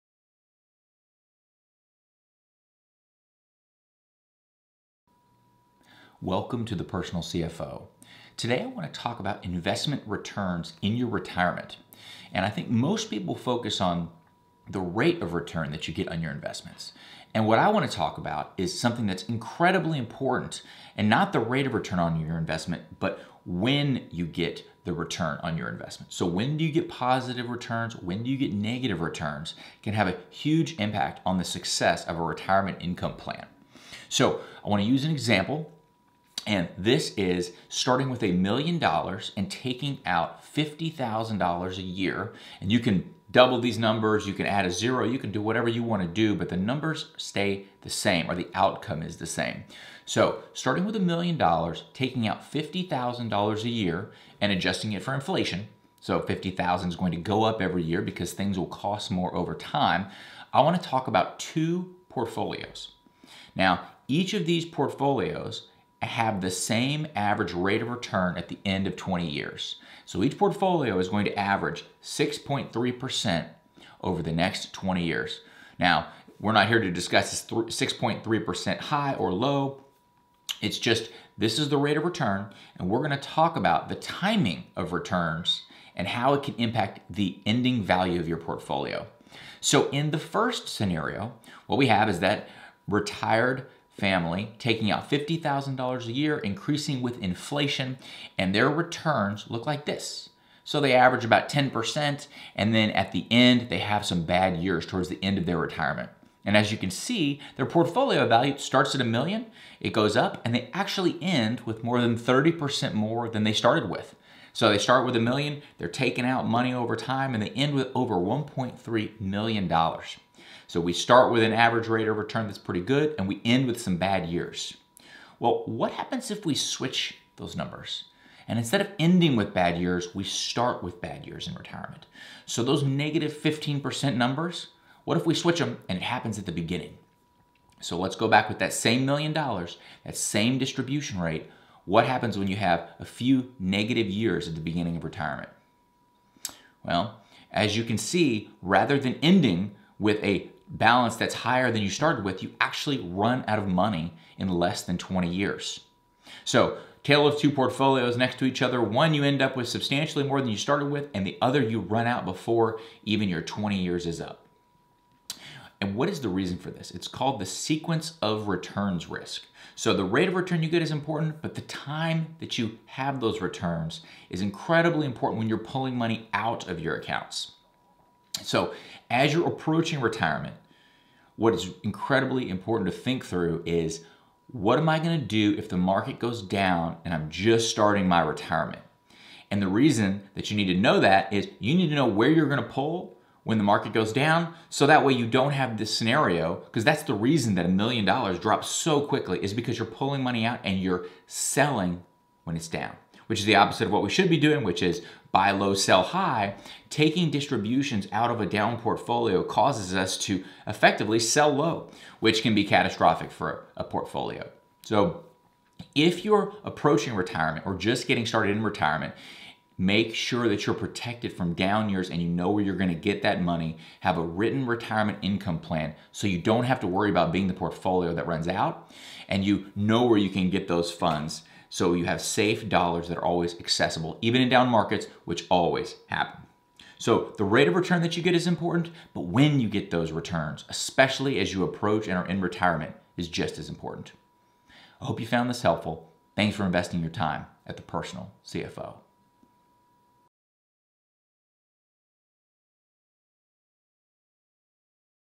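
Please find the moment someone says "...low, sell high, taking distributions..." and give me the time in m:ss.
3:25.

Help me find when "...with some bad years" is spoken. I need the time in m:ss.
2:03.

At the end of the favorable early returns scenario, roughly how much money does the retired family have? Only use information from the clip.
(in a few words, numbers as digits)
over $1.3 million.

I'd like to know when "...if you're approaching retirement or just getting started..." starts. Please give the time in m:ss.
3:35.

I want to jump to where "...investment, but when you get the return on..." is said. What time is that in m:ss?
0:22.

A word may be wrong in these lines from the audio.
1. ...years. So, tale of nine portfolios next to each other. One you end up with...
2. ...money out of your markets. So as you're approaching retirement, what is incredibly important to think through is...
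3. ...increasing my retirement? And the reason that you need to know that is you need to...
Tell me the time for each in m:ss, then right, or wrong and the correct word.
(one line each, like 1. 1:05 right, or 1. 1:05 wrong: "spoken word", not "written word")
1. 2:35 wrong: "two", not "nine"
2. 2:55 wrong: "accounts", not "markets"
3. 3:07 wrong: "starting", not "increasing".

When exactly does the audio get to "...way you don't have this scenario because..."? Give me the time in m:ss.
3:15.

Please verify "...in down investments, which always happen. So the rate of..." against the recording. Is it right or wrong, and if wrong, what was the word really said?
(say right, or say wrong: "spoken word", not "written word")
wrong: "markets", not "investments".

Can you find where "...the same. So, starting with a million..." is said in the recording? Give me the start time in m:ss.
0:49.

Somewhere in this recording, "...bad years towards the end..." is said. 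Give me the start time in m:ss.
1:44.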